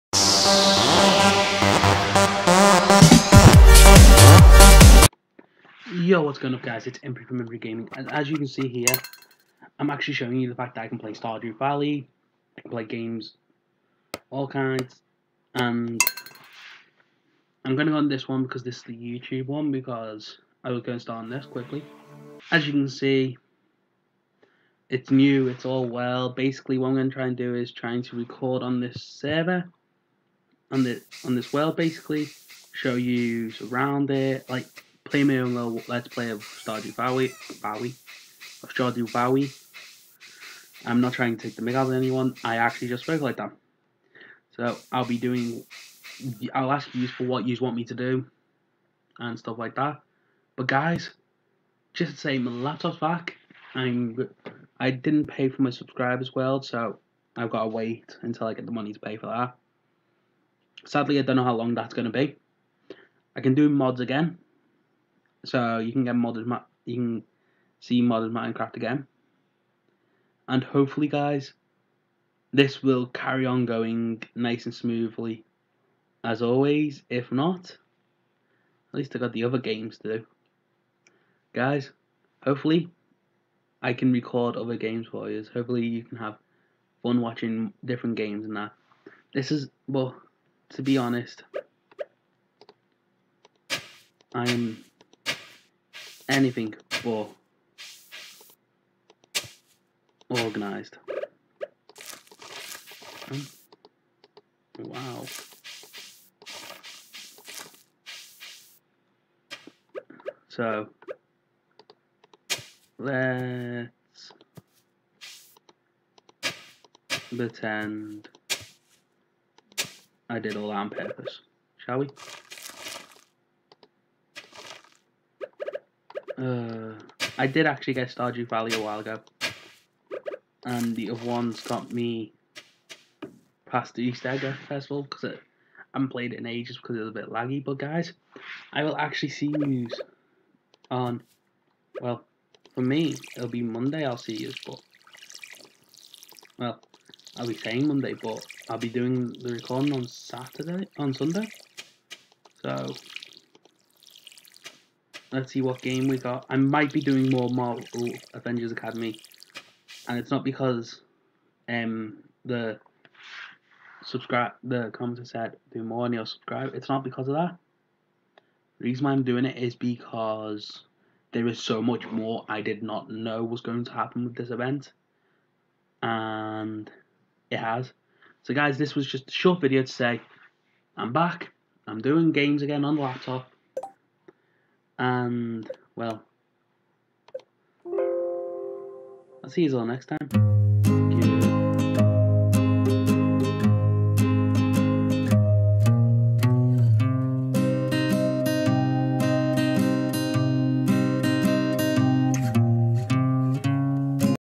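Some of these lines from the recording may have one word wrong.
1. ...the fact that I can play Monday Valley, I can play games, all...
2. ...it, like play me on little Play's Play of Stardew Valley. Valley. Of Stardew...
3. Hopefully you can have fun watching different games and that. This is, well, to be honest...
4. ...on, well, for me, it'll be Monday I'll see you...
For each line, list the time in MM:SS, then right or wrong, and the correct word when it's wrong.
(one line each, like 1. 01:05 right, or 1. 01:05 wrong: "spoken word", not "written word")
1. 00:10 wrong: "Stardew", not "Monday"
2. 00:34 wrong: "Let", not "Play"
3. 01:25 right
4. 02:20 right.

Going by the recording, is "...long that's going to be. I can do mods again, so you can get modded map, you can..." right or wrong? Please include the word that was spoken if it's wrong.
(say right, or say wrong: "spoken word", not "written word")
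right.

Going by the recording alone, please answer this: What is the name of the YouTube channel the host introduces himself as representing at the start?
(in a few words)
Empty Gaming.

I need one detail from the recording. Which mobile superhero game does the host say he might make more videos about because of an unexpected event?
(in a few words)
Marvel Avengers Academy.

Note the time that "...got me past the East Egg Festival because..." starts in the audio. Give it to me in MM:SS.
02:11.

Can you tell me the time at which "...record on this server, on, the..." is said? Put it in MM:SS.
00:28.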